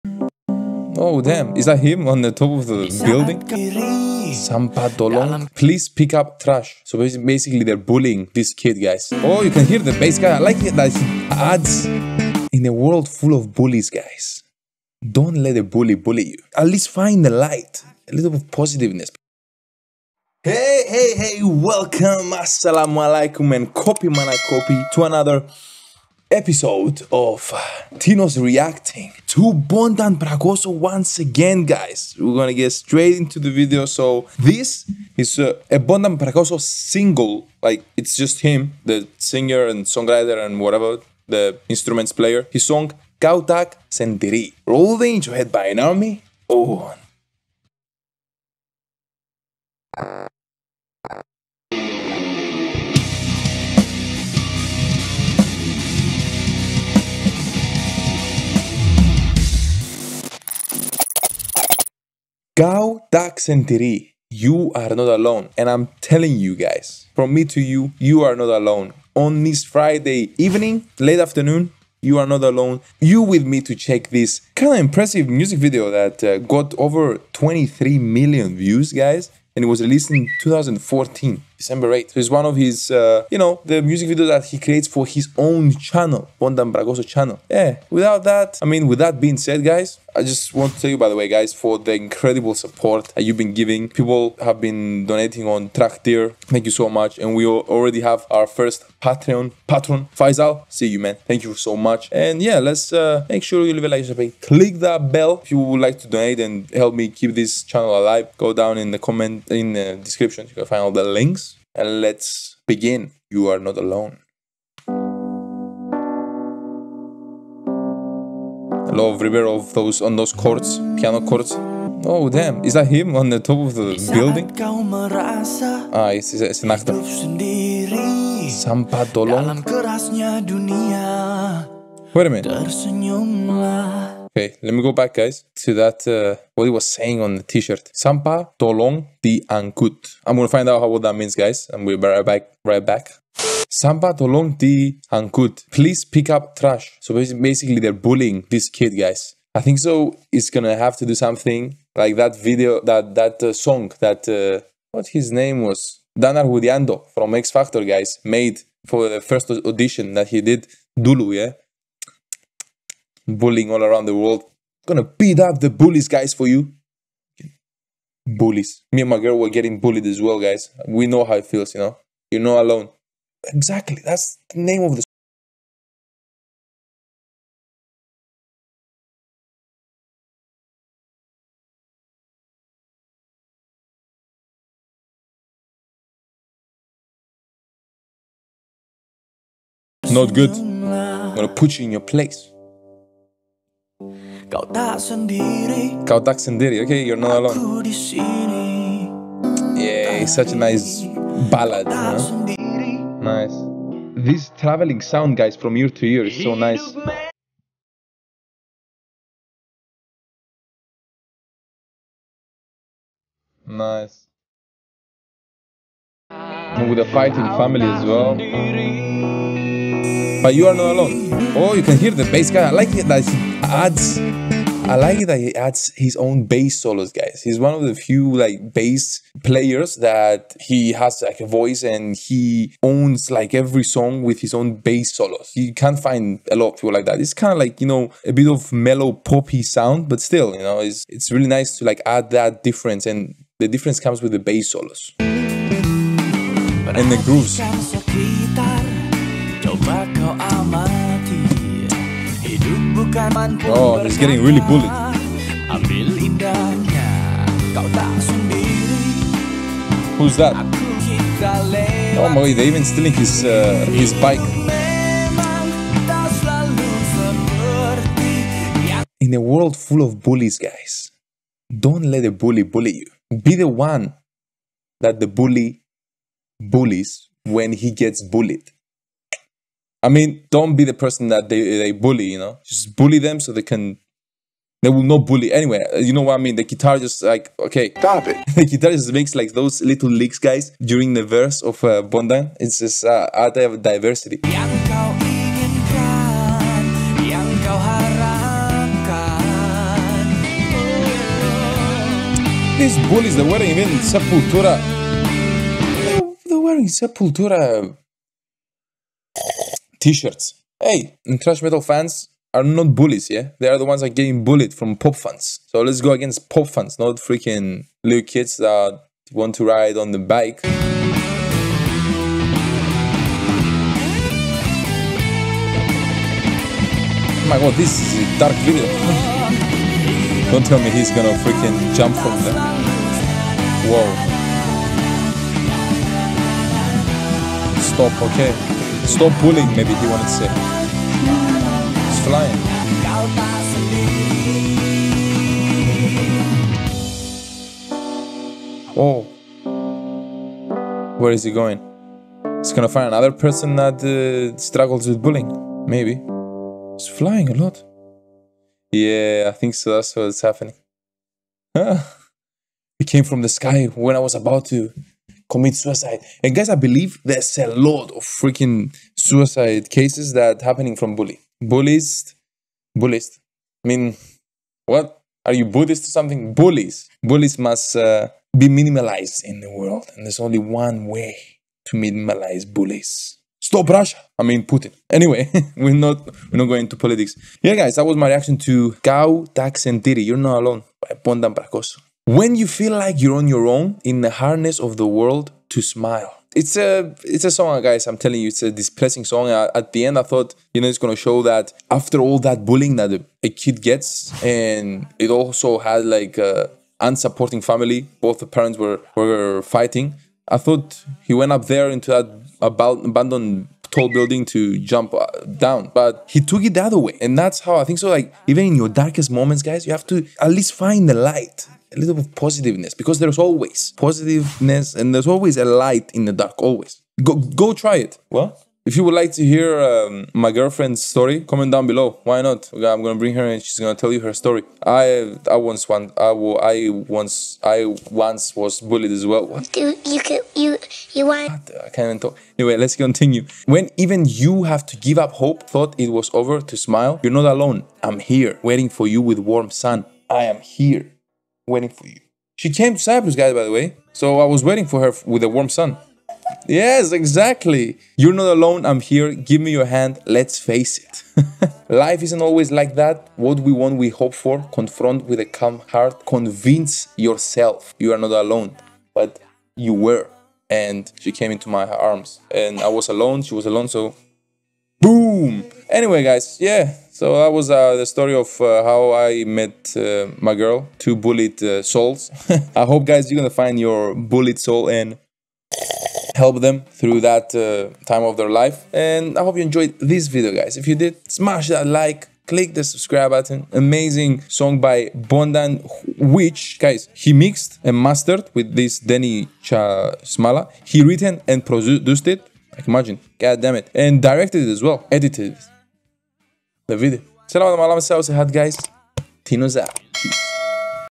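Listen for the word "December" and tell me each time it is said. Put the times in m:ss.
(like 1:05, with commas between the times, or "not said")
1:21.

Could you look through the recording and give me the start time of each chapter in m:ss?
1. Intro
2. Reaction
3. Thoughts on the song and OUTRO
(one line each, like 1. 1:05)
1. 0:19
2. 1:55
3. 6:02.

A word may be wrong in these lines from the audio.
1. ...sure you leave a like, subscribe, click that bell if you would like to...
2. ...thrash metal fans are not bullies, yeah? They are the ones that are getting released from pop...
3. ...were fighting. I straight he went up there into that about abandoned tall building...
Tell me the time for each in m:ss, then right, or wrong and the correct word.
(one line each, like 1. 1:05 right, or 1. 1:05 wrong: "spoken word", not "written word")
1. 1:43 right
2. 5:11 wrong: "bullied", not "released"
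3. 6:49 wrong: "thought", not "straight".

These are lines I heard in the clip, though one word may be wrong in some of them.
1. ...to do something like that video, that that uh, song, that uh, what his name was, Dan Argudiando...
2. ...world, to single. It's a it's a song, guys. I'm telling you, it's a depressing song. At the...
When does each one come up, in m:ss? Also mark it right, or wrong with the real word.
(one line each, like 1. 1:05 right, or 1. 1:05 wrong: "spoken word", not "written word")
1. 2:30 right
2. 6:35 wrong: "smile", not "single".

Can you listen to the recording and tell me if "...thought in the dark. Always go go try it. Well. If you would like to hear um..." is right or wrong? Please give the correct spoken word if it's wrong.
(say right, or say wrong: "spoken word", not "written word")
wrong: "light", not "thought".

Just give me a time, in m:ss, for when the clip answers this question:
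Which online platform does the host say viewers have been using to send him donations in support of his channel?
1:35.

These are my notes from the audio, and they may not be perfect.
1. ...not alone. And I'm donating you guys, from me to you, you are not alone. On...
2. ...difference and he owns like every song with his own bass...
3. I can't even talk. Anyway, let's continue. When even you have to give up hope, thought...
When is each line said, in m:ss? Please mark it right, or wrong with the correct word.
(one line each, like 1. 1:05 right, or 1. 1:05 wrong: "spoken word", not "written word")
1. 1:04 wrong: "telling", not "donating"
2. 3:51 wrong: "voice", not "difference"
3. 7:21 right.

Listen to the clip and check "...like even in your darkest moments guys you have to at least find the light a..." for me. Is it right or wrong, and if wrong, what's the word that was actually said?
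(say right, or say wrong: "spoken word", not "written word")
right.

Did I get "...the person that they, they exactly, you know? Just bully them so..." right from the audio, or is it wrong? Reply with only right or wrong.
wrong.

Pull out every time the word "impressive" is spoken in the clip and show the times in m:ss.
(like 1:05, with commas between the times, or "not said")
1:14.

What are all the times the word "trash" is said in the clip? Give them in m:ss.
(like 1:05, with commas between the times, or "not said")
0:06, 2:26.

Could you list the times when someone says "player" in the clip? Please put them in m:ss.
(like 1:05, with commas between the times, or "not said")
0:42, 3:49.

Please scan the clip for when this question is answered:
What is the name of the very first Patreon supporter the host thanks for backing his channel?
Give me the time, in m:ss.
1:40.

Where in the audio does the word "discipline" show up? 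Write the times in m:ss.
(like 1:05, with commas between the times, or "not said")
not said.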